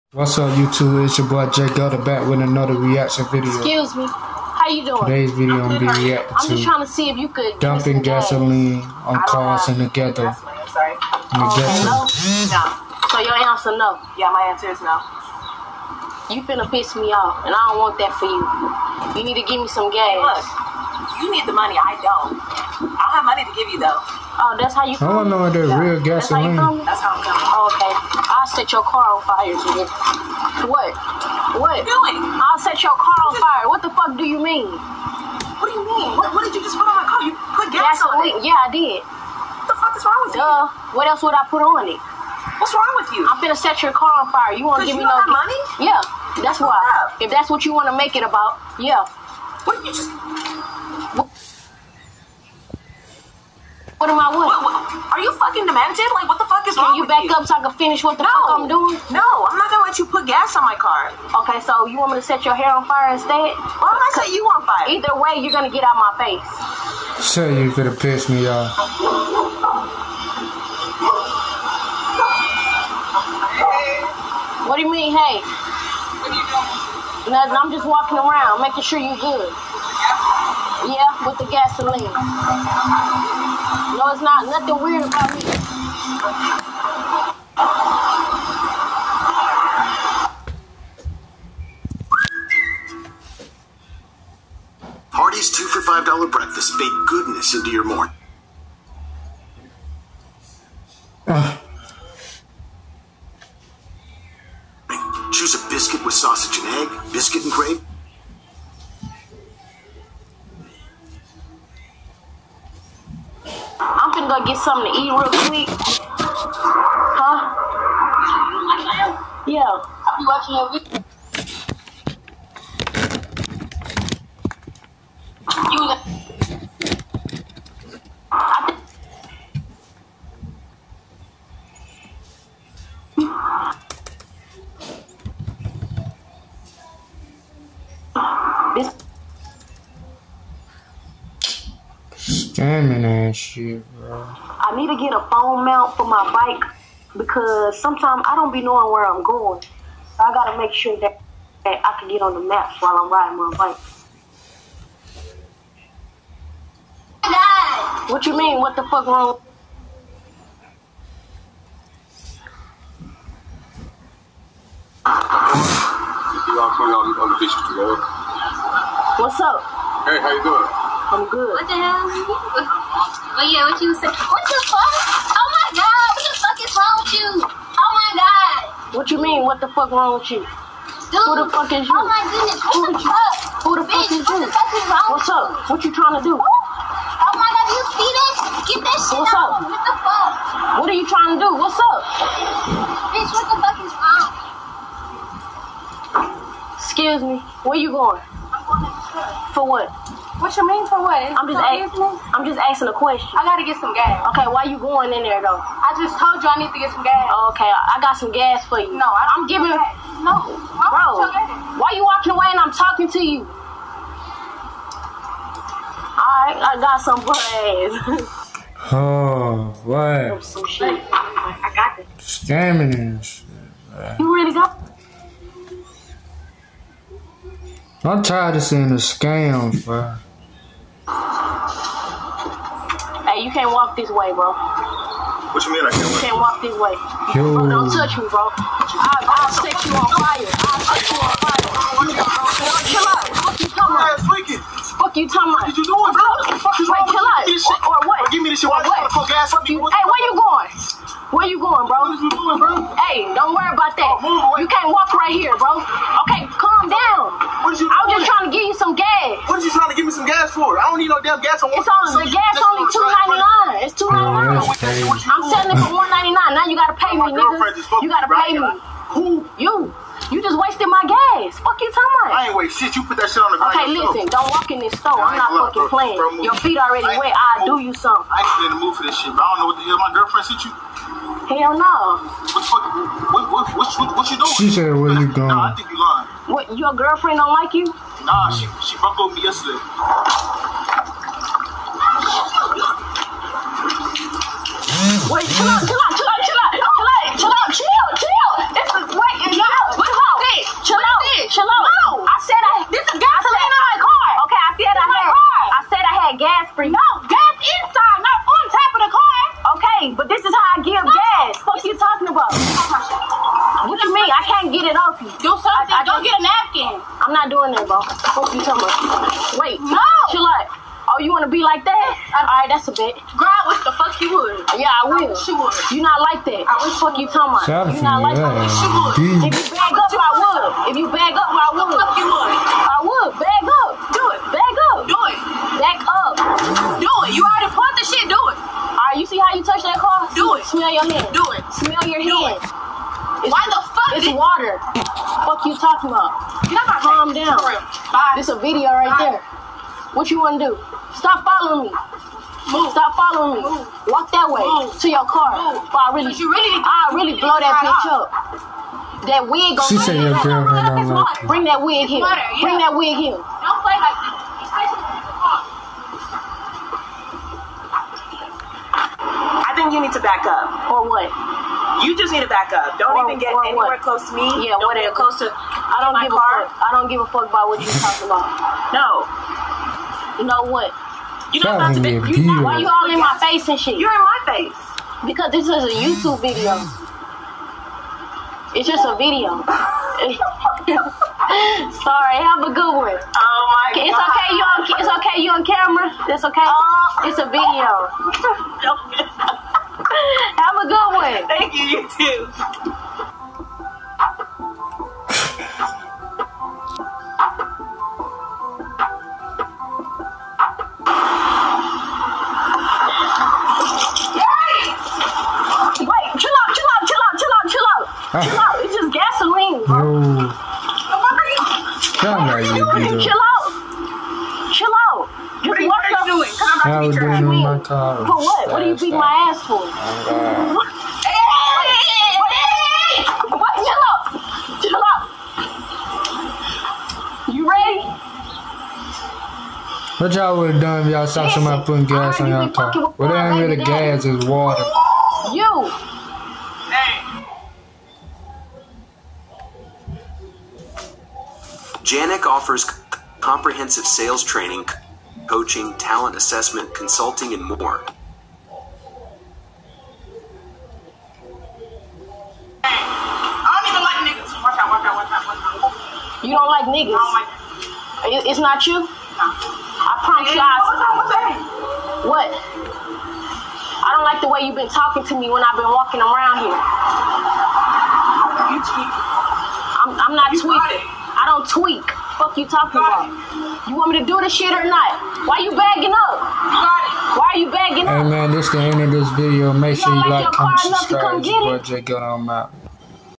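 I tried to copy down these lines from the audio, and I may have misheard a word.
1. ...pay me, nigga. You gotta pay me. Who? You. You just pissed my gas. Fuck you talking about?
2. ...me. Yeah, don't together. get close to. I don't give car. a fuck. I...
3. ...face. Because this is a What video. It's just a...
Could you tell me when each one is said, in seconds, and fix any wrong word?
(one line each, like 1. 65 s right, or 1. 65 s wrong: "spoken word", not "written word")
1. 266 s wrong: "wasted", not "pissed"
2. 374 s wrong: "whatever", not "together"
3. 384 s wrong: "YouTube", not "What".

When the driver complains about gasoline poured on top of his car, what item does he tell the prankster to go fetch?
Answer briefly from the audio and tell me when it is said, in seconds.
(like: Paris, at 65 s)
A napkin, at 316 s.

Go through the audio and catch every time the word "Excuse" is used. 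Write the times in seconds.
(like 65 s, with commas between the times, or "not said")
3 s, 196 s.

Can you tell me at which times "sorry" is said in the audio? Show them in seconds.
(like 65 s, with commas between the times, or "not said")
10 s, 391 s.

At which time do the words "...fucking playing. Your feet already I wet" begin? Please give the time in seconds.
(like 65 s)
275 s.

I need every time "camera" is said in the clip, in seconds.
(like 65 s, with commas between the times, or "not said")
395 s.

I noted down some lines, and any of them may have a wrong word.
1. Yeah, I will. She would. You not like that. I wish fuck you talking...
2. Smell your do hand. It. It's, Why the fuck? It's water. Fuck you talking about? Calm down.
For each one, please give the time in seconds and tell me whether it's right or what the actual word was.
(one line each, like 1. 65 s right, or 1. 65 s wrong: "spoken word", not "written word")
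1. 324 s right
2. 341 s right.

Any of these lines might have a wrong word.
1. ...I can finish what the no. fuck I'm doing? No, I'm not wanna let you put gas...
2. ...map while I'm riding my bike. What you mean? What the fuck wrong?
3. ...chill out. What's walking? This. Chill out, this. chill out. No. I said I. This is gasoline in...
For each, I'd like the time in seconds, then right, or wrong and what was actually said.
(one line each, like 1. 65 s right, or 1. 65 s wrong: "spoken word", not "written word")
1. 57 s wrong: "gonna", not "wanna"
2. 152 s right
3. 299 s wrong: "wrong", not "walking".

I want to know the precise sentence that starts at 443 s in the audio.
Well, that ain't really gas, it's water.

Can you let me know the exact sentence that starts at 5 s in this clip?
Today's video I'm gonna be reacting I'm just trying to see if you could dumping gasoline on cars and together.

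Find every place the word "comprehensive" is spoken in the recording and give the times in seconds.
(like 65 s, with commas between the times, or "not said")
453 s.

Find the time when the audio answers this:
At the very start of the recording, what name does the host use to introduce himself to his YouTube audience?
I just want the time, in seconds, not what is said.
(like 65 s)
1 s.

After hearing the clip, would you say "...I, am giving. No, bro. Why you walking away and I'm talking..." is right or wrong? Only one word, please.
right.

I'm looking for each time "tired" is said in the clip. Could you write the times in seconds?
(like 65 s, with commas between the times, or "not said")
228 s.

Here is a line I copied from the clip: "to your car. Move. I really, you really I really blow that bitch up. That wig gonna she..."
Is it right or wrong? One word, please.
right.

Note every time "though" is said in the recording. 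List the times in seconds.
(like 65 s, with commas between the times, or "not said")
23 s, 205 s.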